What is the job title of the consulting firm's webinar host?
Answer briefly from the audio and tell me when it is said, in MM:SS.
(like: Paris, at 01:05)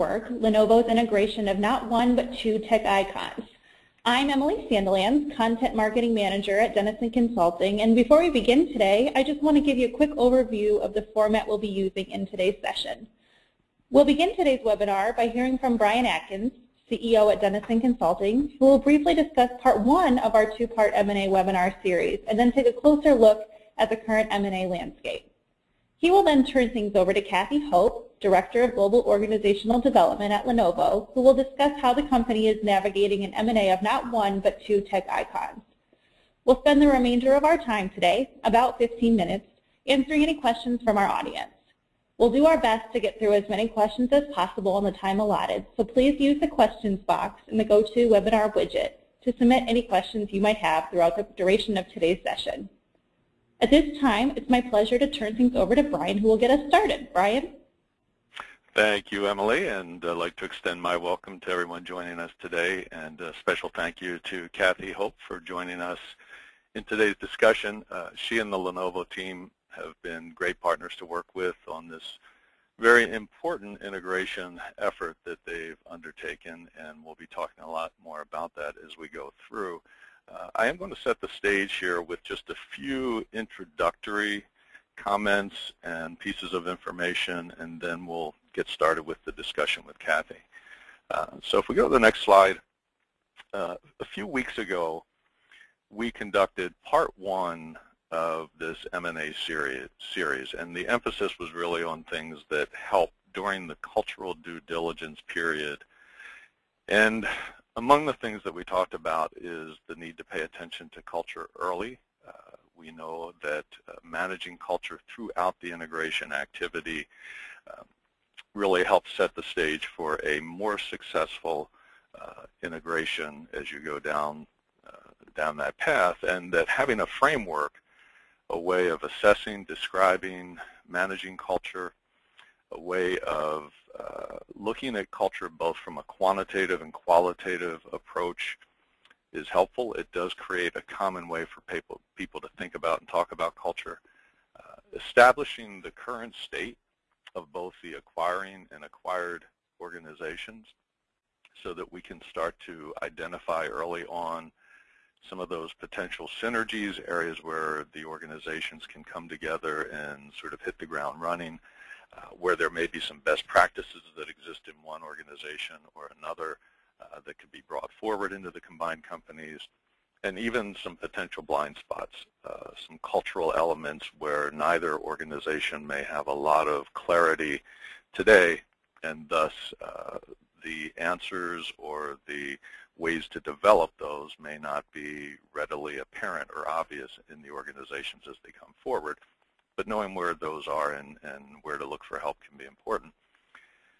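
Content Marketing Manager, at 00:05.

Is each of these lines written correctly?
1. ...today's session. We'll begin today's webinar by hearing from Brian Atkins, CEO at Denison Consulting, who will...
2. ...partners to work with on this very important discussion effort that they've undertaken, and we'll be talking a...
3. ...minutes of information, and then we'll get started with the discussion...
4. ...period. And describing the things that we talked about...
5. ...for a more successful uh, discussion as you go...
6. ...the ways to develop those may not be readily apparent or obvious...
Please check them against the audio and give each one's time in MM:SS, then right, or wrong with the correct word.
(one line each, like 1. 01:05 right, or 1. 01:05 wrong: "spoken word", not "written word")
1. 00:12 right
2. 01:10 wrong: "integration", not "discussion"
3. 01:26 wrong: "pieces", not "minutes"
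4. 01:45 wrong: "among", not "describing"
5. 01:59 wrong: "integration", not "discussion"
6. 03:02 right.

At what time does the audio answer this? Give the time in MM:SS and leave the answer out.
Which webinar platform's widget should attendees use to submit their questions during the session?
00:47.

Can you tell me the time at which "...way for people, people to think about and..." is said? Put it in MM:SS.
02:21.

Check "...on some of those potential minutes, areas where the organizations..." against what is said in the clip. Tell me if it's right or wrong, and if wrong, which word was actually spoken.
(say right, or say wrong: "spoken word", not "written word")
wrong: "synergies", not "minutes".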